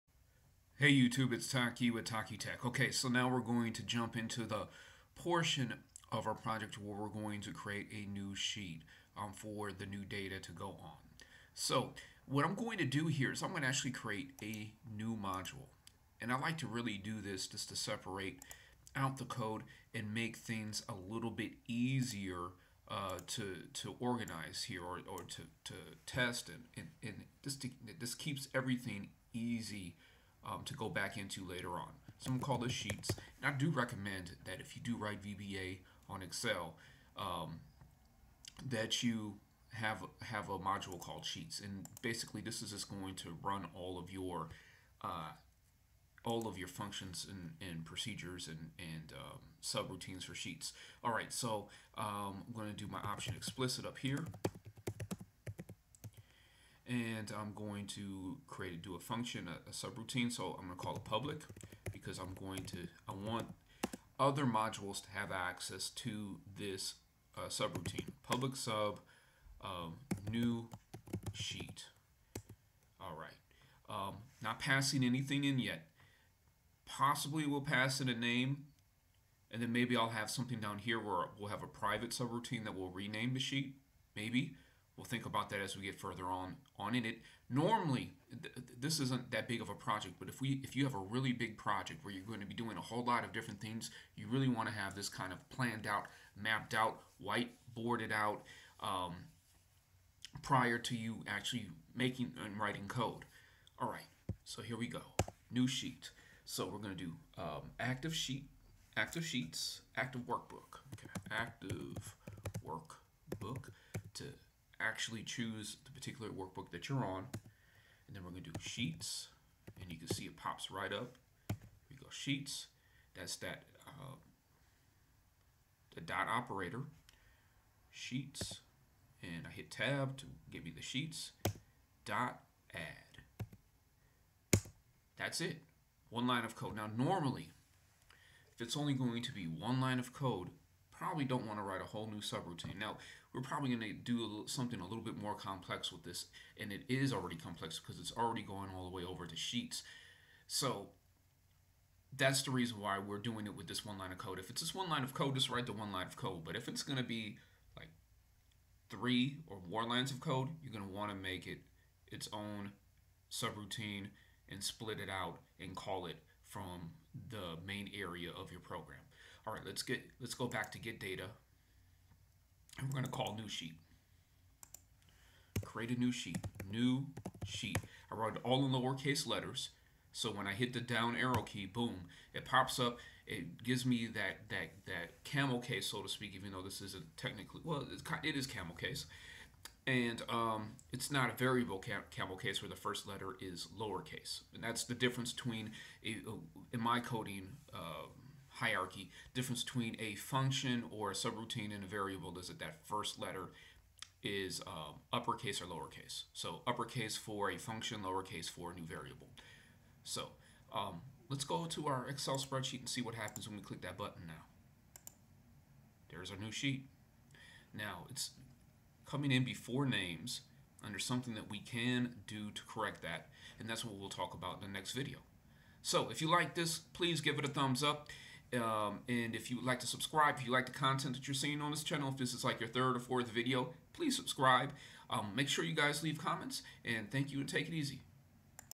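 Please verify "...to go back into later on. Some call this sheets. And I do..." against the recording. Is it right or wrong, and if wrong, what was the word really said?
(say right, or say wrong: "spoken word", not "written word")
right.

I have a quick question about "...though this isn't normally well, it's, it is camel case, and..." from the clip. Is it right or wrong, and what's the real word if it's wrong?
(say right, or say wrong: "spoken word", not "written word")
wrong: "technically", not "normally".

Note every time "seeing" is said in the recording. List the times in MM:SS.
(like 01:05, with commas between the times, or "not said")
03:51.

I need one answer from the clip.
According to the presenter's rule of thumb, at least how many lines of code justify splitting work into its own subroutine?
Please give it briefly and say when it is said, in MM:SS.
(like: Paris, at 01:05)
3, at 02:38.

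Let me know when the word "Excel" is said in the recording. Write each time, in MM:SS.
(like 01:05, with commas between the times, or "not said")
00:36, 03:32.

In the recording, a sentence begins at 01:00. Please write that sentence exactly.
So I'm going to call it public because I'm going to, I want other modules to have access to this uh, subroutine.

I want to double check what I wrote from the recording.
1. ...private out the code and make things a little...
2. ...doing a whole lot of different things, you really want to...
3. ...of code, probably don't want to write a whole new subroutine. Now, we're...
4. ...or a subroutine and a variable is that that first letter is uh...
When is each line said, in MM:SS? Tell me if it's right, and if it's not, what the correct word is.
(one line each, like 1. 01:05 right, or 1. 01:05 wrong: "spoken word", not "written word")
1. 00:17 wrong: "separate", not "private"
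2. 01:32 right
3. 02:19 right
4. 03:20 right.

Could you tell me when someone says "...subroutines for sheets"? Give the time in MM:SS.
00:49.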